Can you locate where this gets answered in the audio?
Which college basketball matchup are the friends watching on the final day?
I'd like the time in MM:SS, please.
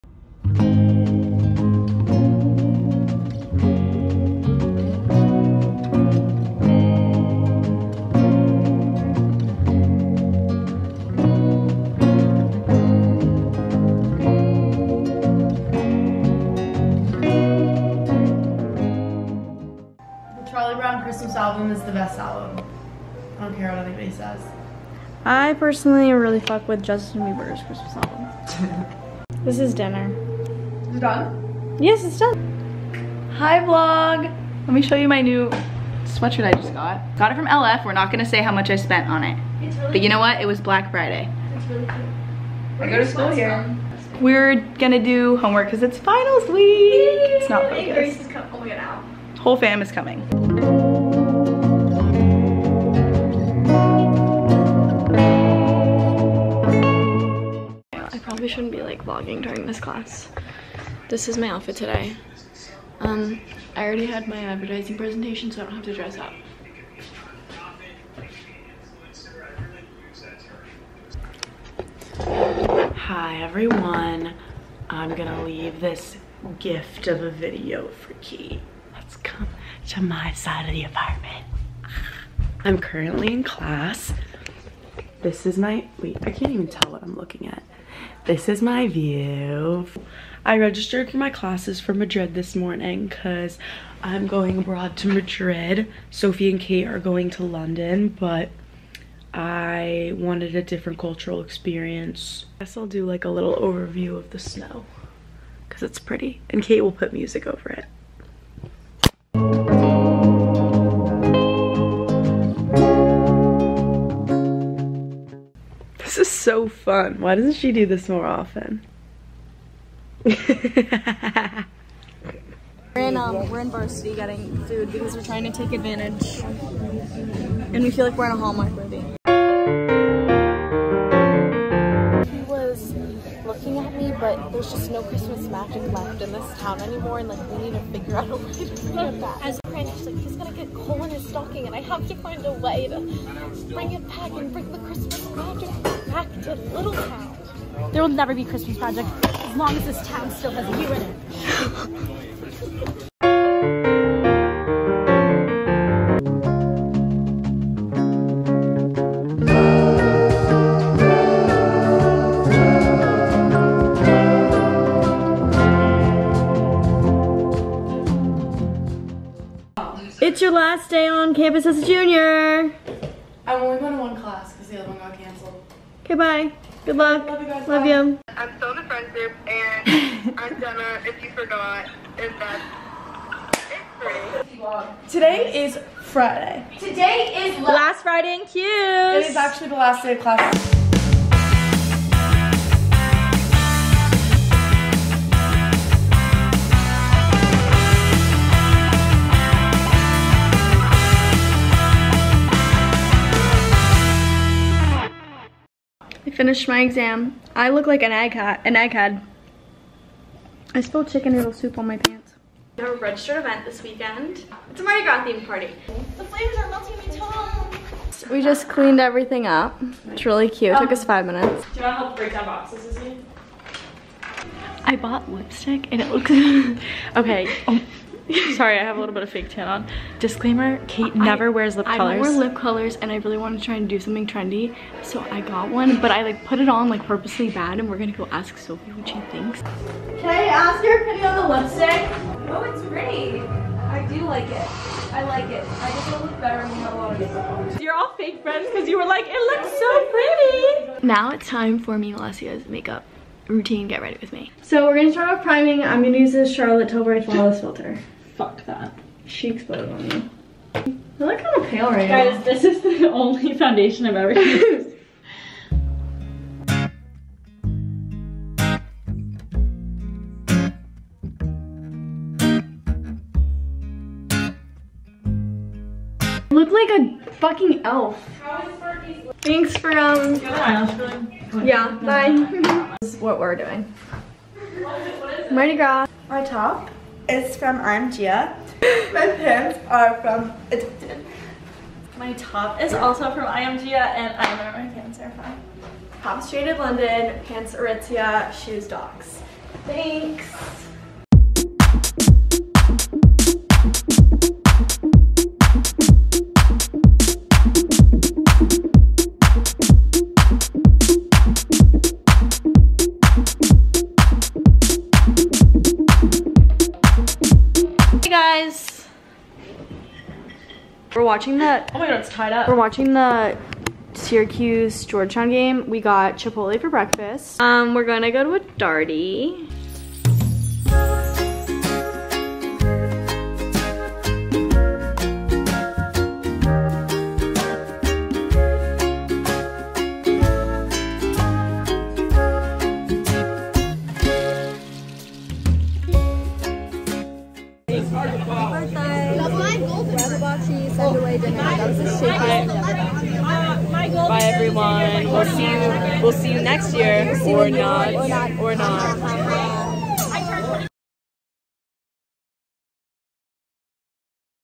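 05:24.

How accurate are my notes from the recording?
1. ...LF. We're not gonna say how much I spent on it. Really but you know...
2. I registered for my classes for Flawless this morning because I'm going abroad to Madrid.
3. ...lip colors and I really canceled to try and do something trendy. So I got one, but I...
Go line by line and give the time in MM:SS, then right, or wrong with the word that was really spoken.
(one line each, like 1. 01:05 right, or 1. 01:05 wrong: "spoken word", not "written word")
1. 00:37 right
2. 01:30 wrong: "Madrid", not "Flawless"
3. 03:52 wrong: "wanted", not "canceled".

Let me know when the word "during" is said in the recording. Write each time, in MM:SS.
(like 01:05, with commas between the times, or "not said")
00:59.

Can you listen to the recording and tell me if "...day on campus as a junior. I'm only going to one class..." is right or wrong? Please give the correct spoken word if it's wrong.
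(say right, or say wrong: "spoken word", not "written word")
right.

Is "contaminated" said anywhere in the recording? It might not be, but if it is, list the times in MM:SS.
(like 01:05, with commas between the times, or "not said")
not said.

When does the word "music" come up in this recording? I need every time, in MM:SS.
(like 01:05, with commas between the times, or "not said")
01:47.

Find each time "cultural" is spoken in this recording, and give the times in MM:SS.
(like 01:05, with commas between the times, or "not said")
01:40.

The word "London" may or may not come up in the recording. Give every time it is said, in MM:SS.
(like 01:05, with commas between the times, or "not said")
01:37, 04:56.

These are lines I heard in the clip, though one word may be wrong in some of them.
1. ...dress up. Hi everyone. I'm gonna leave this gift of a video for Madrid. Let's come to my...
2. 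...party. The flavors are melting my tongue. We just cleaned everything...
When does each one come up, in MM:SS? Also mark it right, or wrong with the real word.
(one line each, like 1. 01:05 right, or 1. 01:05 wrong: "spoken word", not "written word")
1. 01:05 wrong: "Key", not "Madrid"
2. 03:35 right.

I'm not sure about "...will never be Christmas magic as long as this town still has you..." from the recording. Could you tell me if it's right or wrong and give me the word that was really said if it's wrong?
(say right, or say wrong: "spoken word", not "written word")
right.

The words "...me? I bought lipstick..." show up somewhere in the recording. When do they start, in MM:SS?
03:43.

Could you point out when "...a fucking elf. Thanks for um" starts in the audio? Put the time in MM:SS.
04:36.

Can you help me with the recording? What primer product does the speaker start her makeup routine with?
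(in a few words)
Charlotte Tilbury Flawless Filter.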